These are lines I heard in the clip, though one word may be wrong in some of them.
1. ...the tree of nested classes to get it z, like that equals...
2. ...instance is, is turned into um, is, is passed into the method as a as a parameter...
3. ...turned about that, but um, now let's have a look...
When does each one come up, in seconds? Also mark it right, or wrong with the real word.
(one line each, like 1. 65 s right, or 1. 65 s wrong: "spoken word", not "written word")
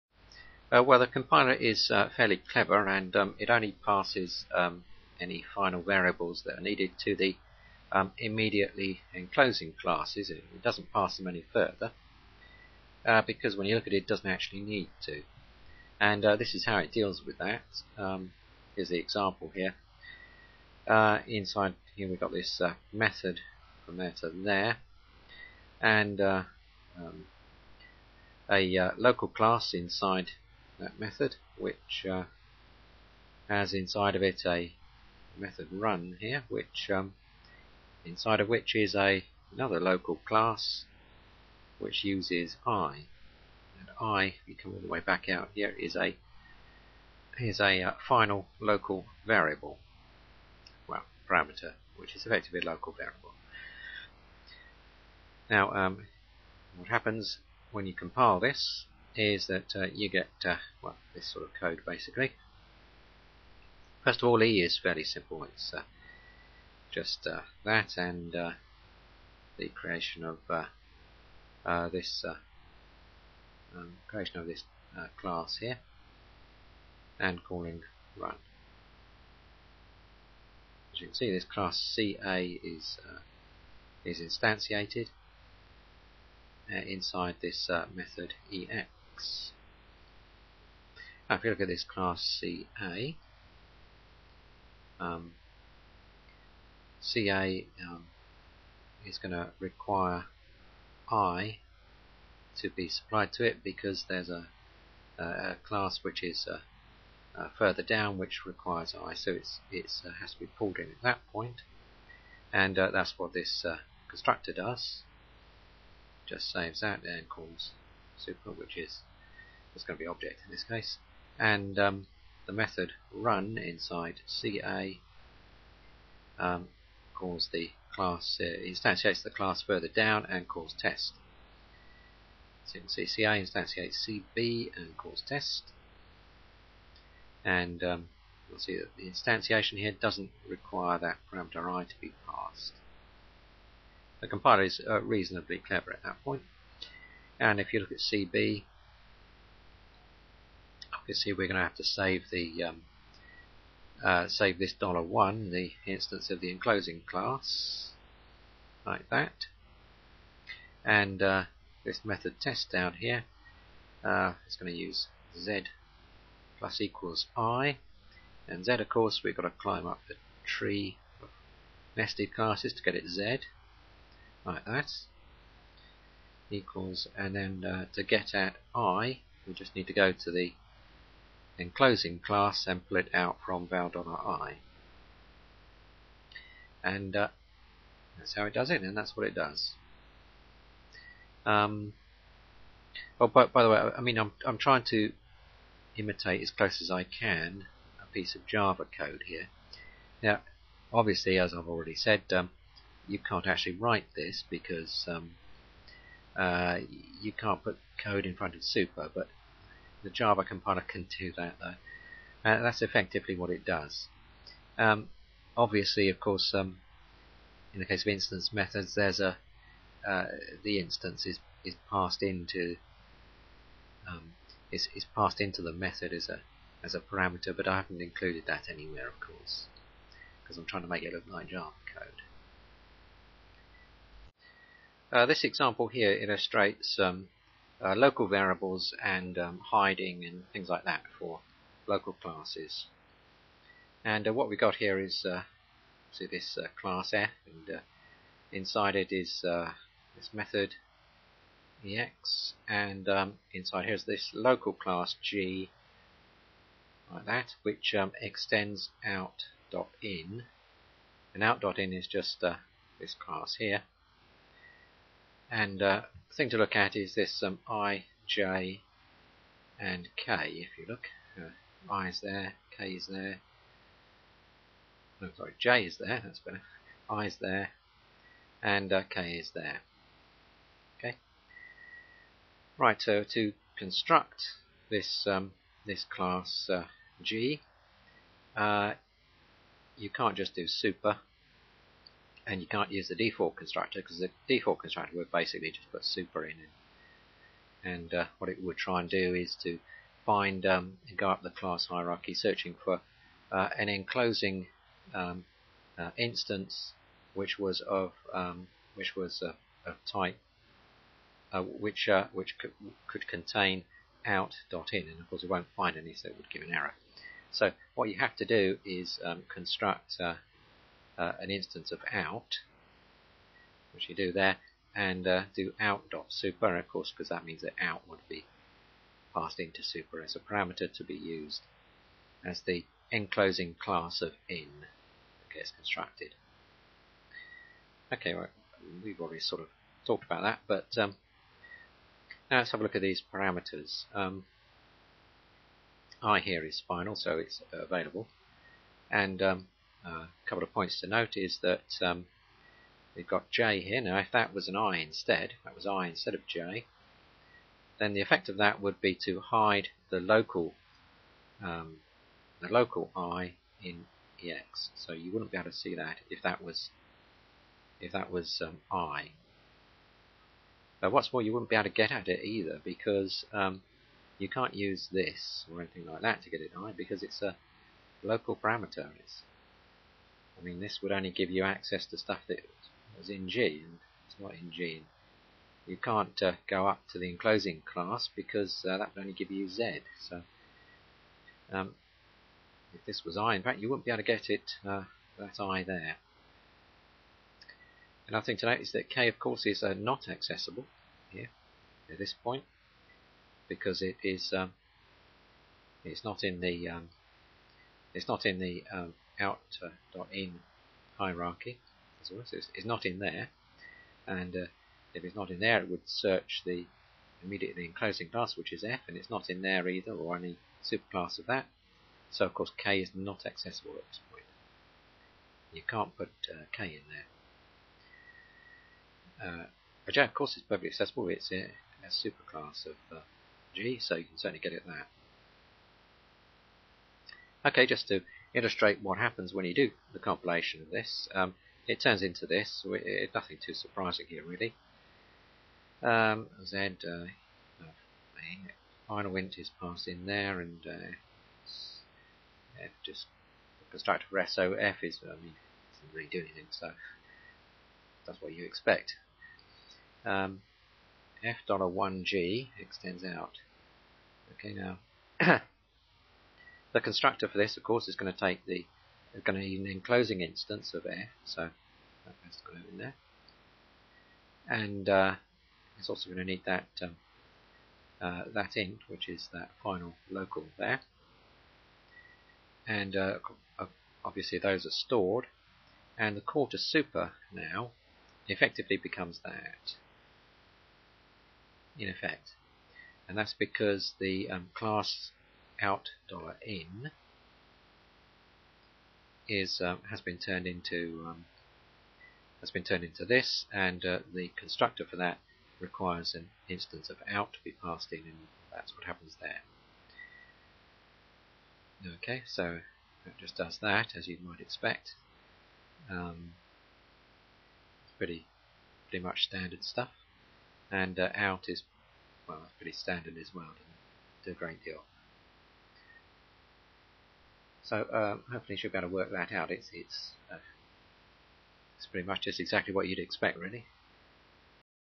1. 170 s right
2. 220 s wrong: "passed", not "turned"
3. 340 s wrong: "talked", not "turned".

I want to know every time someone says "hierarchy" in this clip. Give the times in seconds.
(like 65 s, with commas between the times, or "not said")
301 s, 411 s.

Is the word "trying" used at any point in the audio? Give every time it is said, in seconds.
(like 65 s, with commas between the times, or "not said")
194 s, 230 s.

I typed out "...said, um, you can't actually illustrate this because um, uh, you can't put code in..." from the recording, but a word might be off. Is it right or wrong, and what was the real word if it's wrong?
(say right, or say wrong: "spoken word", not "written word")
wrong: "write", not "illustrate".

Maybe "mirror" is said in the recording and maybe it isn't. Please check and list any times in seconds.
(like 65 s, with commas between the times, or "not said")
not said.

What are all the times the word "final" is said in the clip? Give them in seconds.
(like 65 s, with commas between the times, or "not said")
5 s, 48 s, 346 s, 449 s, 479 s.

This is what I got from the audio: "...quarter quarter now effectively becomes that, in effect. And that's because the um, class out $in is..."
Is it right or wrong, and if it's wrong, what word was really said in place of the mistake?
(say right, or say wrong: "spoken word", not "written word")
wrong: "super", not "quarter".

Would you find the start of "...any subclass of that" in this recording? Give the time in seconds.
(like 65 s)
420 s.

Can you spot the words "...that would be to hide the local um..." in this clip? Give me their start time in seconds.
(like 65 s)
358 s.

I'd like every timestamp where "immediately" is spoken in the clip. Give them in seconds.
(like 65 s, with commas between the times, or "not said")
8 s, 417 s.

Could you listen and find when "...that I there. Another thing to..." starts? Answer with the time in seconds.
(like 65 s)
395 s.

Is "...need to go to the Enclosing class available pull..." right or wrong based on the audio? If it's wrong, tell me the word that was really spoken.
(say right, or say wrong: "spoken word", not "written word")
wrong: "sample", not "available".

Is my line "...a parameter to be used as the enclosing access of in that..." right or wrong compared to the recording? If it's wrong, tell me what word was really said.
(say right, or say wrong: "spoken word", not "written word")
wrong: "class", not "access".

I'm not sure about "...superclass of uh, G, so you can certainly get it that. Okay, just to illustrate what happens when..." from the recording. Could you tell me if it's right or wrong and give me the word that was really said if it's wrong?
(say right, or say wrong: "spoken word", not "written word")
right.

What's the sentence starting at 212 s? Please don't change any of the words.
Uh, that's effectively what it does.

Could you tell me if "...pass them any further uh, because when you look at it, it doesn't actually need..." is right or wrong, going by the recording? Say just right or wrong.
right.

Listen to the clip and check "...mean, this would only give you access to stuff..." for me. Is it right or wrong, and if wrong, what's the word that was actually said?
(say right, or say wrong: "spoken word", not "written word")
right.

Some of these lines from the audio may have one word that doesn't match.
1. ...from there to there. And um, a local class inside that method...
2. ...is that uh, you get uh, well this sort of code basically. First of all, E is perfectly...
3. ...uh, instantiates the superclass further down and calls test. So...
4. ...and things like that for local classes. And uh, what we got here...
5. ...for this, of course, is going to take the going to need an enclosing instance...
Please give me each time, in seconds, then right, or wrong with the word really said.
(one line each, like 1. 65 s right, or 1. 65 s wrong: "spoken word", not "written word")
1. 23 s right
2. 59 s wrong: "fairly", not "perfectly"
3. 128 s wrong: "class", not "superclass"
4. 240 s right
5. 467 s right.